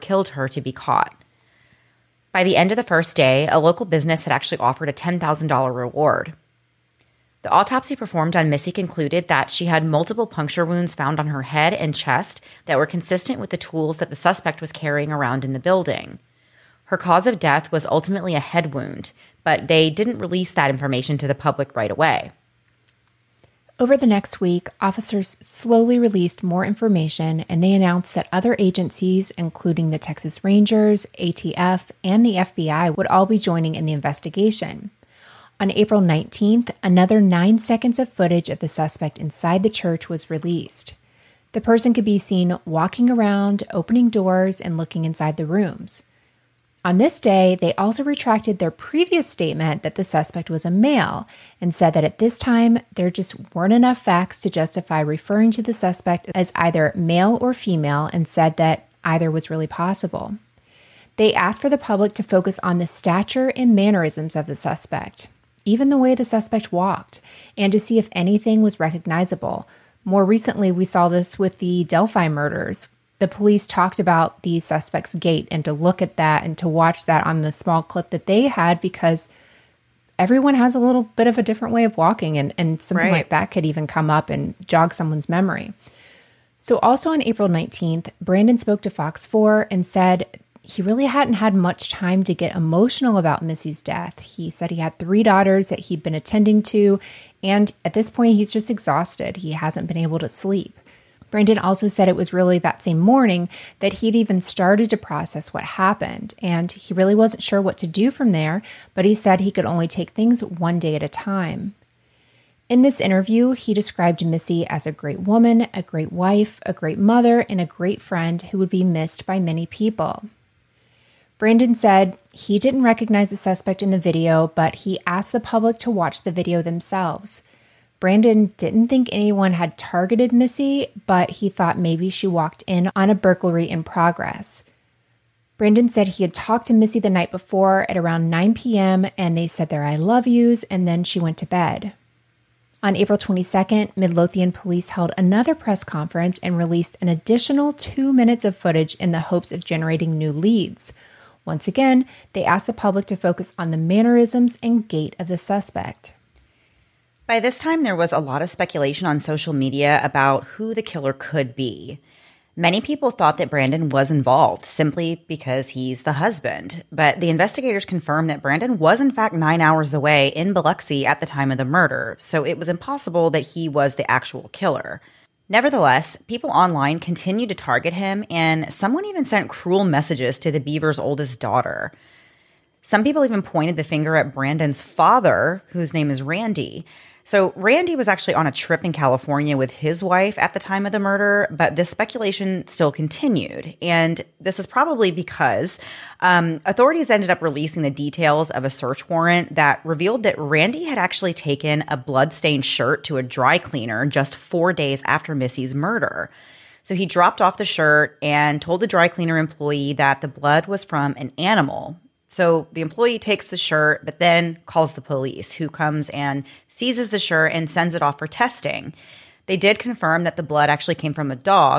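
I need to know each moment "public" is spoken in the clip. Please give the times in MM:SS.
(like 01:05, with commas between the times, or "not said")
00:21, 01:01, 02:05, 02:32.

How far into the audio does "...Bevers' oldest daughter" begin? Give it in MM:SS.
03:00.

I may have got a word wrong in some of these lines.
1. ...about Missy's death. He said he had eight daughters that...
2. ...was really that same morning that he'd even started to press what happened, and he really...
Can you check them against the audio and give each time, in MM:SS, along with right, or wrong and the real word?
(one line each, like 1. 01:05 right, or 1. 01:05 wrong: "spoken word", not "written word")
1. 01:33 wrong: "three", not "eight"
2. 01:42 wrong: "process", not "press".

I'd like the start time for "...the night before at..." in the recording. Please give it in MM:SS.
02:16.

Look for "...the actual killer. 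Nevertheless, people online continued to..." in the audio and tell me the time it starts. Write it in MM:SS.
02:53.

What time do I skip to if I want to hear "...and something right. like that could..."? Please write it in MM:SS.
01:22.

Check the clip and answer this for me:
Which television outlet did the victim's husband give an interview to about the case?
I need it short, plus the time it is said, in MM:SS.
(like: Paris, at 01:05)
Fox 4, at 01:28.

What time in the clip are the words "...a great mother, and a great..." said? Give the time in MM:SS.
01:56.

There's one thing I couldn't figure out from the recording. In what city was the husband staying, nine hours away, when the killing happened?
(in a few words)
Biloxi.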